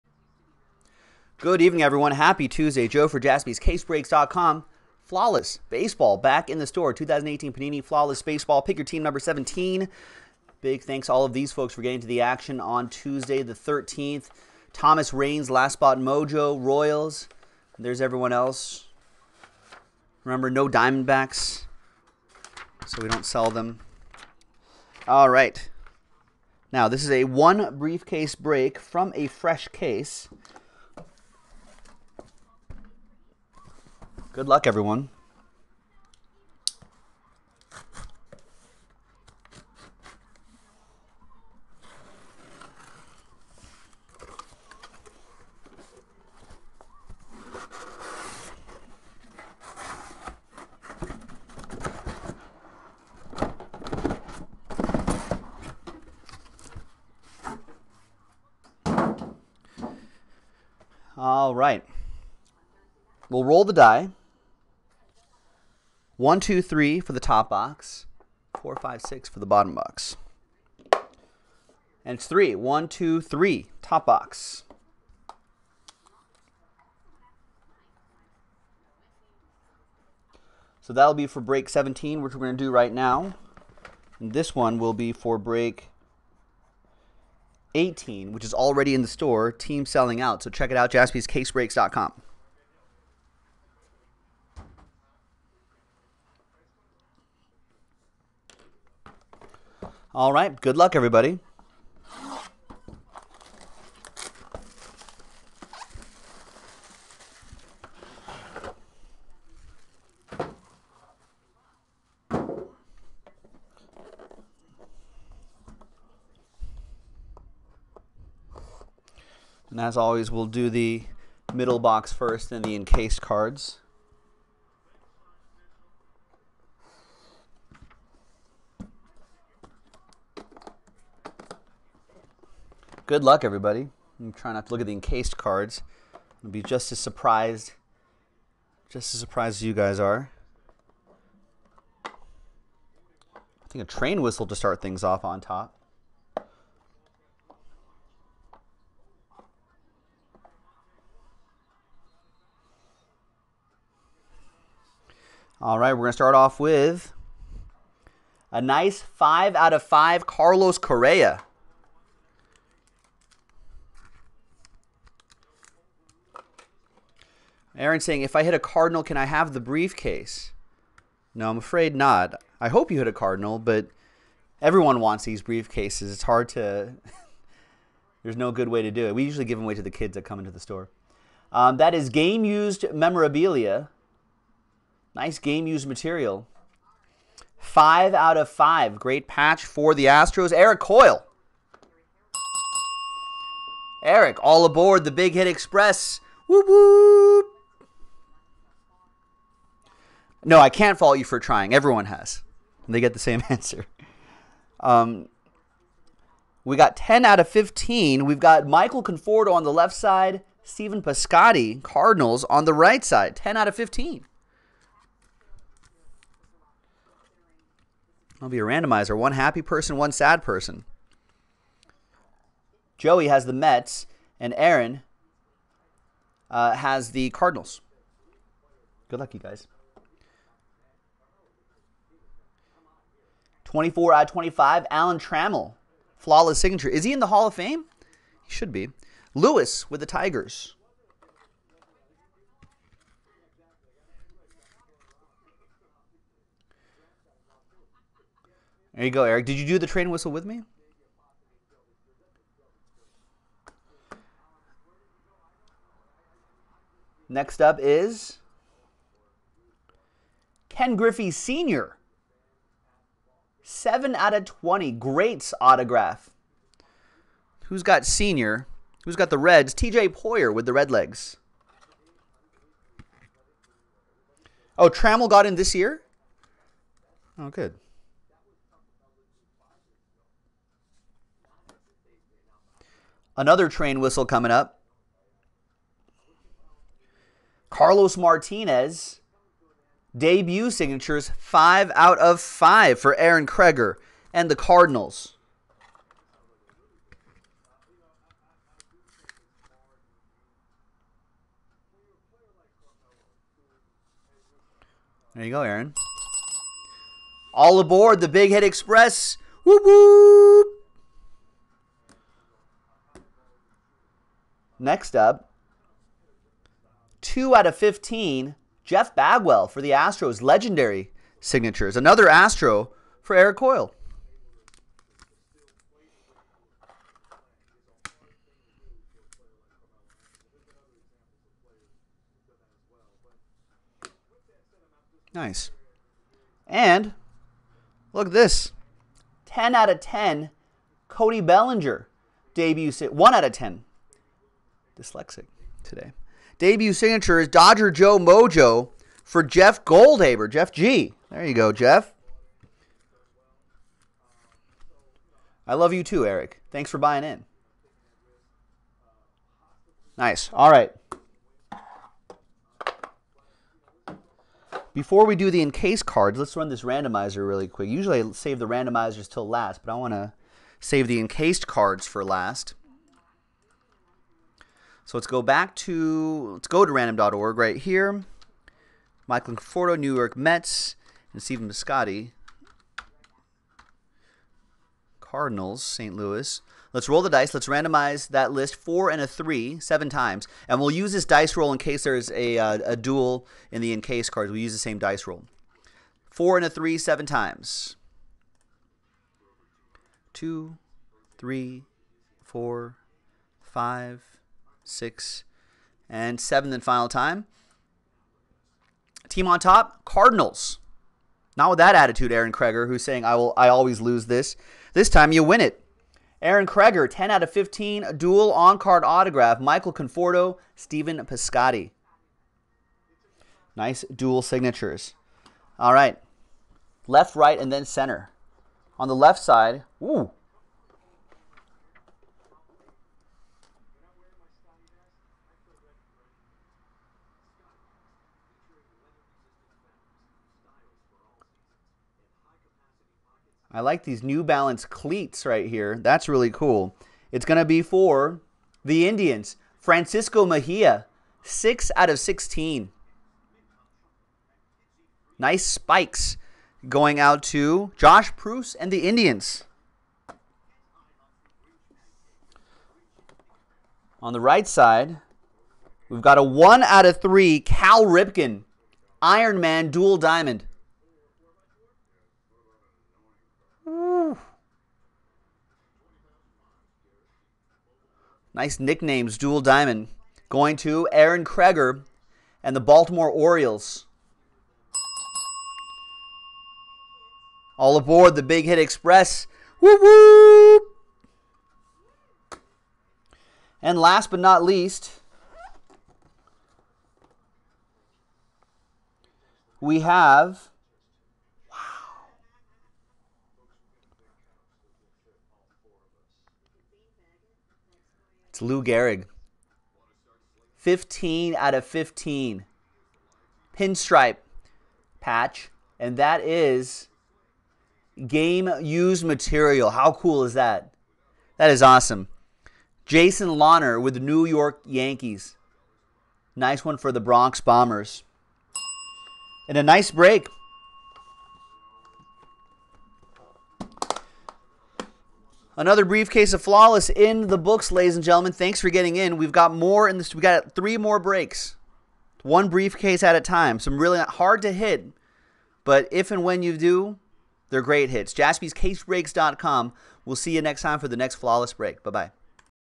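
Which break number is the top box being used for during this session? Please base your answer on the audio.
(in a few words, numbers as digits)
17.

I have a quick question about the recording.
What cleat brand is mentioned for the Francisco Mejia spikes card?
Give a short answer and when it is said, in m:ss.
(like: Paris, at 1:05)
New Balance, at 7:24.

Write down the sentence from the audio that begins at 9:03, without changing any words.
Some really hard to hit, but if and when you do, they're great hits.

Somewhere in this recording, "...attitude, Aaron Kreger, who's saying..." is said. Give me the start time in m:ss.
6:51.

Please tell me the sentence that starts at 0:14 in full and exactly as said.
Thomas Raines, Last Spot Mojo, Royals.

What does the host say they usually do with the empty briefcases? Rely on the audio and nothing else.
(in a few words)
give them away to the kids.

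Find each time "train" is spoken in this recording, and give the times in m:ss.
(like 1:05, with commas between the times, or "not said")
2:23, 4:09, 4:43.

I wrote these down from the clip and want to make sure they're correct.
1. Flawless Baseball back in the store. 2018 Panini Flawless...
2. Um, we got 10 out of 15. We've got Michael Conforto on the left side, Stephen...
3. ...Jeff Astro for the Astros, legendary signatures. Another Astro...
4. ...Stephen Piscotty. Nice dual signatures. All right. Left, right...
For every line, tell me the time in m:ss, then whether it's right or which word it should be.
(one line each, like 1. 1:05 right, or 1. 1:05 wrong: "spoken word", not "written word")
1. 0:05 right
2. 3:24 right
3. 5:18 wrong: "Bagwell", not "Astro"
4. 7:00 right.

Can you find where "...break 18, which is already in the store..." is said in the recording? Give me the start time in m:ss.
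1:25.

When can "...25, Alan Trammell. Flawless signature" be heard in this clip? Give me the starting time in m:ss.
3:54.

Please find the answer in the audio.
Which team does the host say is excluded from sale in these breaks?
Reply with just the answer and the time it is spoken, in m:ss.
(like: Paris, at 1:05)
Diamondbacks, at 0:20.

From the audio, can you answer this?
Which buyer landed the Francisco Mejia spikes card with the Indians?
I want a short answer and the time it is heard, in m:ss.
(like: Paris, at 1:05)
Josh Proust, at 7:37.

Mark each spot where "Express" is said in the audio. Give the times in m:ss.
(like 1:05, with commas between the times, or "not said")
3:15, 5:08, 8:08.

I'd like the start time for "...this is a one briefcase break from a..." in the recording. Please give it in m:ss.
0:26.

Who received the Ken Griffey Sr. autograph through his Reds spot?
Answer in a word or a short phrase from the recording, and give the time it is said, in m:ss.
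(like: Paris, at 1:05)
TJ Poyer, at 4:29.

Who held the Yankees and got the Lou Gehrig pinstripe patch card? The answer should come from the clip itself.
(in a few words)
Jason Lawner.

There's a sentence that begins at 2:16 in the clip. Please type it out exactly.
I'll be just as surprised, just as surprised as you guys are.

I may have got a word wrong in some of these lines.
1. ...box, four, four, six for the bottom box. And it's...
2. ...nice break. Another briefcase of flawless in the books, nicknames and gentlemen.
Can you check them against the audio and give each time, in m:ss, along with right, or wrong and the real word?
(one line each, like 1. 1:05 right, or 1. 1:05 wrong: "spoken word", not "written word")
1. 1:07 wrong: "five", not "four"
2. 8:49 wrong: "ladies", not "nicknames".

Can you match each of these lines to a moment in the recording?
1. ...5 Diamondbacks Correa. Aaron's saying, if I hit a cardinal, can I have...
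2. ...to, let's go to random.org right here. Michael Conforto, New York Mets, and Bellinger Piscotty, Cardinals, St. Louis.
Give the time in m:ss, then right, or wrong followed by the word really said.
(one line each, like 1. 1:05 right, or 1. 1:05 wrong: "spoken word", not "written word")
1. 2:39 wrong: "Carlos", not "Diamondbacks"
2. 6:15 wrong: "Stephen", not "Bellinger".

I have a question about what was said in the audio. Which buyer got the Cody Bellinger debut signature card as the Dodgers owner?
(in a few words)
Jeff Goldhaber.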